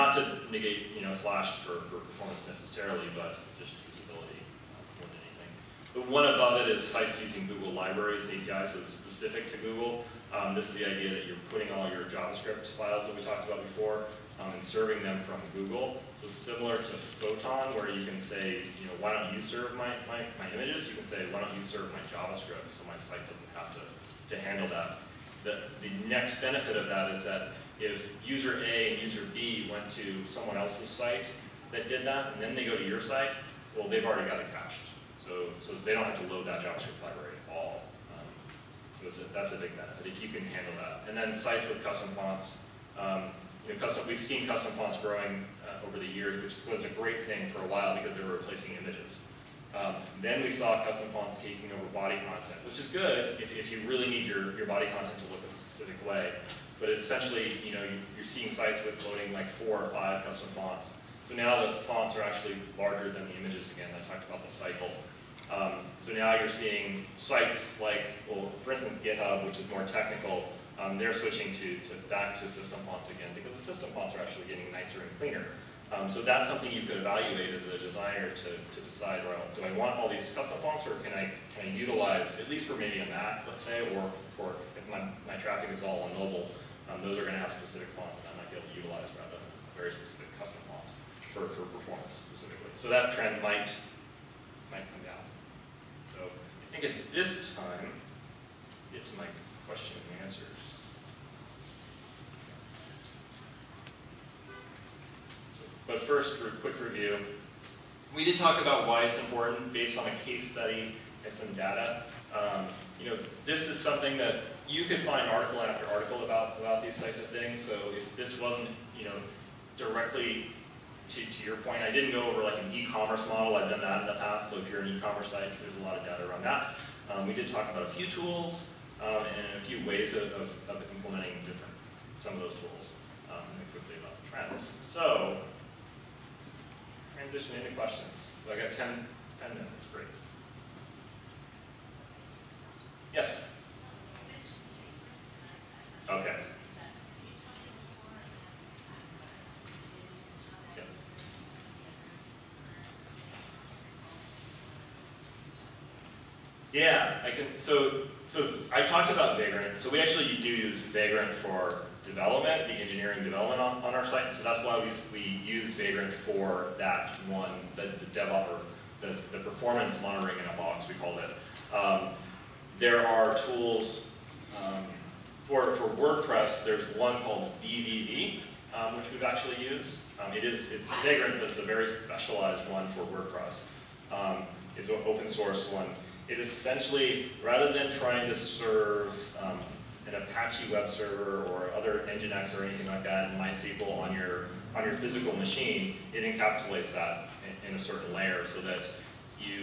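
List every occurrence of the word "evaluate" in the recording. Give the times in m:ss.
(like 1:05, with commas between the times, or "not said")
1:16.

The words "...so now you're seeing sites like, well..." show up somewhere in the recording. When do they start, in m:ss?
1:05.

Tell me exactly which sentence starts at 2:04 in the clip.
So if you're an e-commerce site, there's a lot of data around that.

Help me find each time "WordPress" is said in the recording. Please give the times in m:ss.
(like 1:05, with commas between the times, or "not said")
2:55, 3:03.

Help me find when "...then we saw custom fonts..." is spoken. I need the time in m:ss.
0:50.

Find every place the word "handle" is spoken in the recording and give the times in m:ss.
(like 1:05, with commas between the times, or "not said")
0:24, 0:40.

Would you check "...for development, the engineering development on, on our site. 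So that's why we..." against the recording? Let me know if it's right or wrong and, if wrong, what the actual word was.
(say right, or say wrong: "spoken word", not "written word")
right.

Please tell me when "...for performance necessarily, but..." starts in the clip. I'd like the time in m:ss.
0:01.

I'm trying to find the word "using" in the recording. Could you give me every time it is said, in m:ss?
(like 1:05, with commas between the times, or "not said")
0:07.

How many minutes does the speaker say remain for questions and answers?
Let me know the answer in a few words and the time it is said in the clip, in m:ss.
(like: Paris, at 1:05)
10, at 2:19.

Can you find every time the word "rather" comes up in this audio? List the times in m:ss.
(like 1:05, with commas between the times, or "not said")
1:29, 3:07.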